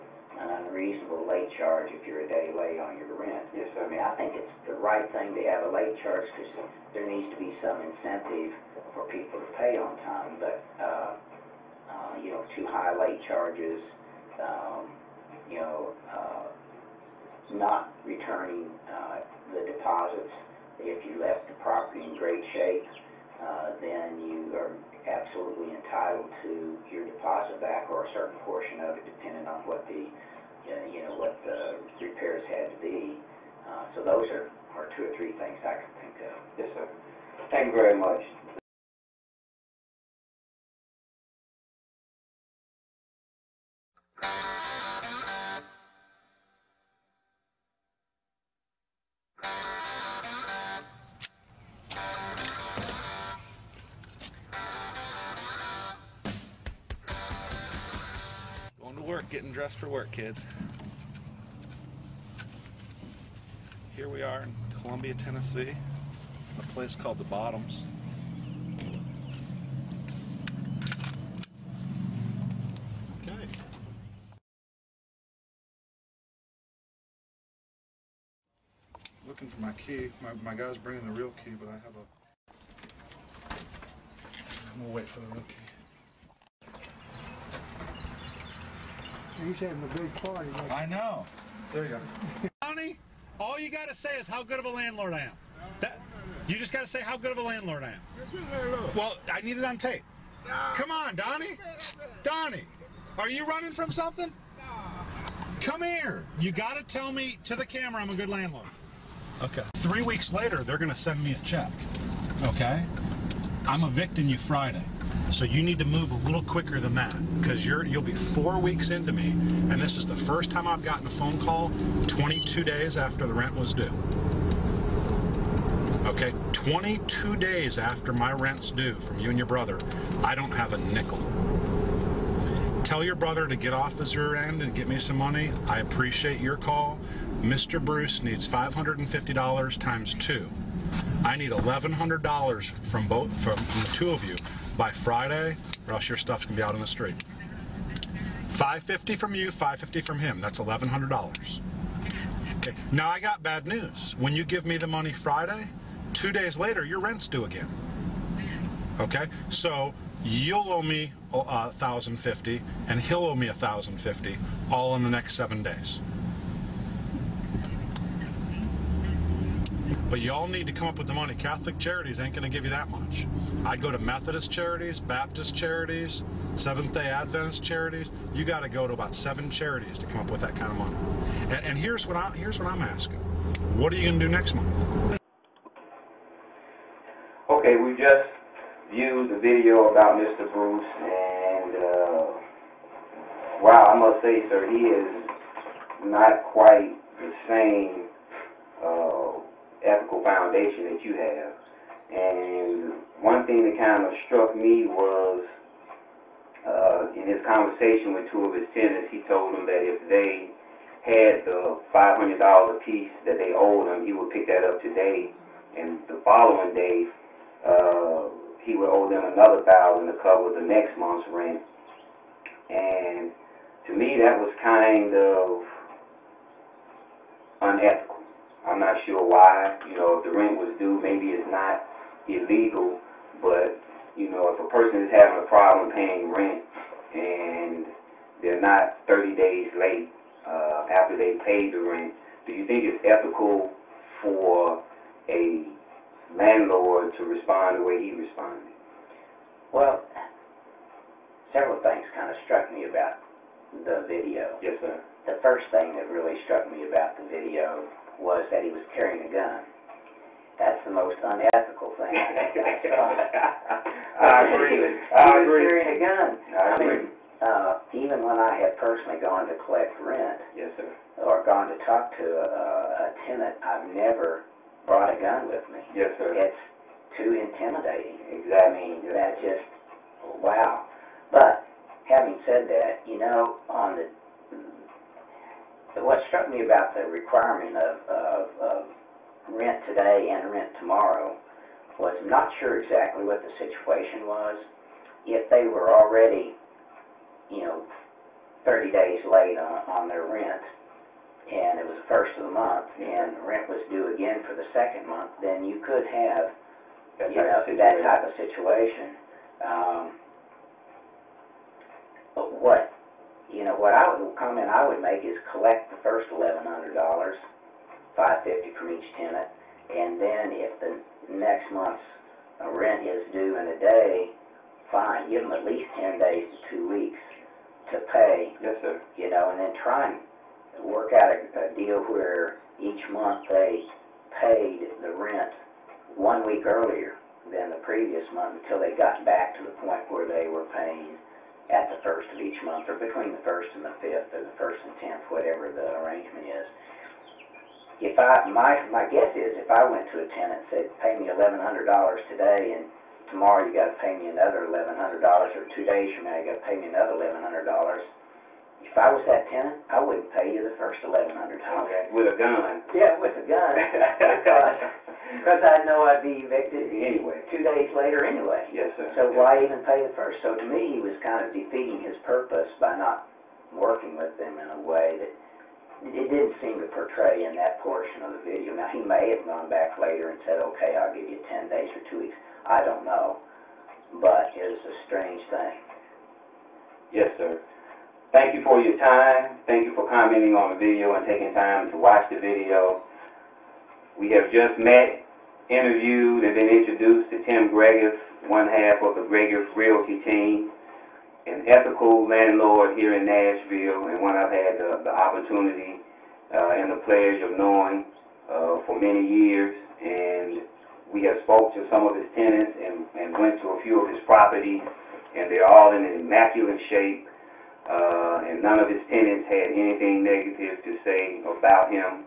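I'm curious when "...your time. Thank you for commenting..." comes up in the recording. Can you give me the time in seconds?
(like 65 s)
388 s.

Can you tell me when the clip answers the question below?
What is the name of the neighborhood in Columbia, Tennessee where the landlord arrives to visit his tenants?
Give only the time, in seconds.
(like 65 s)
67 s.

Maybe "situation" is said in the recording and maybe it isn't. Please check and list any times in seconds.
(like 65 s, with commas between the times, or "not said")
293 s, 308 s.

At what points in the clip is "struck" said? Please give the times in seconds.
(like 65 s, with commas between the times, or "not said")
204 s, 252 s, 256 s, 286 s.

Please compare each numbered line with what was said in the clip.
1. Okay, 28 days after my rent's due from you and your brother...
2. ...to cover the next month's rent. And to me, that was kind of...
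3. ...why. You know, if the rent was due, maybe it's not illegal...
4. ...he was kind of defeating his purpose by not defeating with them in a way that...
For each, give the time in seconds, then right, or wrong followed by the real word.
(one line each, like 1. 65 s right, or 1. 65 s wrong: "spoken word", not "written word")
1. 126 s wrong: "22", not "28"
2. 220 s right
3. 229 s right
4. 370 s wrong: "working", not "defeating".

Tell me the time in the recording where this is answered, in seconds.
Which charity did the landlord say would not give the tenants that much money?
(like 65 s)
171 s.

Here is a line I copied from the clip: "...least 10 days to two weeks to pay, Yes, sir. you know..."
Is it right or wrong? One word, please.
right.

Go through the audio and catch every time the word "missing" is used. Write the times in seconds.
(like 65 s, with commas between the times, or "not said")
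not said.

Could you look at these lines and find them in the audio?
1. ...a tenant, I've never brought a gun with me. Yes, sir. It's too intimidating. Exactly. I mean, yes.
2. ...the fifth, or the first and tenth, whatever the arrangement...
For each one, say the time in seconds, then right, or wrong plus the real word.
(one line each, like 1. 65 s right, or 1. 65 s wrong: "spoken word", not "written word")
1. 273 s right
2. 343 s right.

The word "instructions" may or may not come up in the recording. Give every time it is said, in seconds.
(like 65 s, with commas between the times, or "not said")
not said.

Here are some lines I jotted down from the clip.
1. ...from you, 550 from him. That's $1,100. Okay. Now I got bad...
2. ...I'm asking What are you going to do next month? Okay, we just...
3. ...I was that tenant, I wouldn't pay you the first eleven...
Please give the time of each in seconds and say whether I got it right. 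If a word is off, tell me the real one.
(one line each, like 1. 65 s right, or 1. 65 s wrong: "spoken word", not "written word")
1. 149 s right
2. 182 s right
3. 358 s right.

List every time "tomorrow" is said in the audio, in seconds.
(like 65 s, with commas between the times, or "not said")
290 s, 353 s.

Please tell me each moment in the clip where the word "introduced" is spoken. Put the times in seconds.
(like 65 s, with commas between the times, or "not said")
396 s.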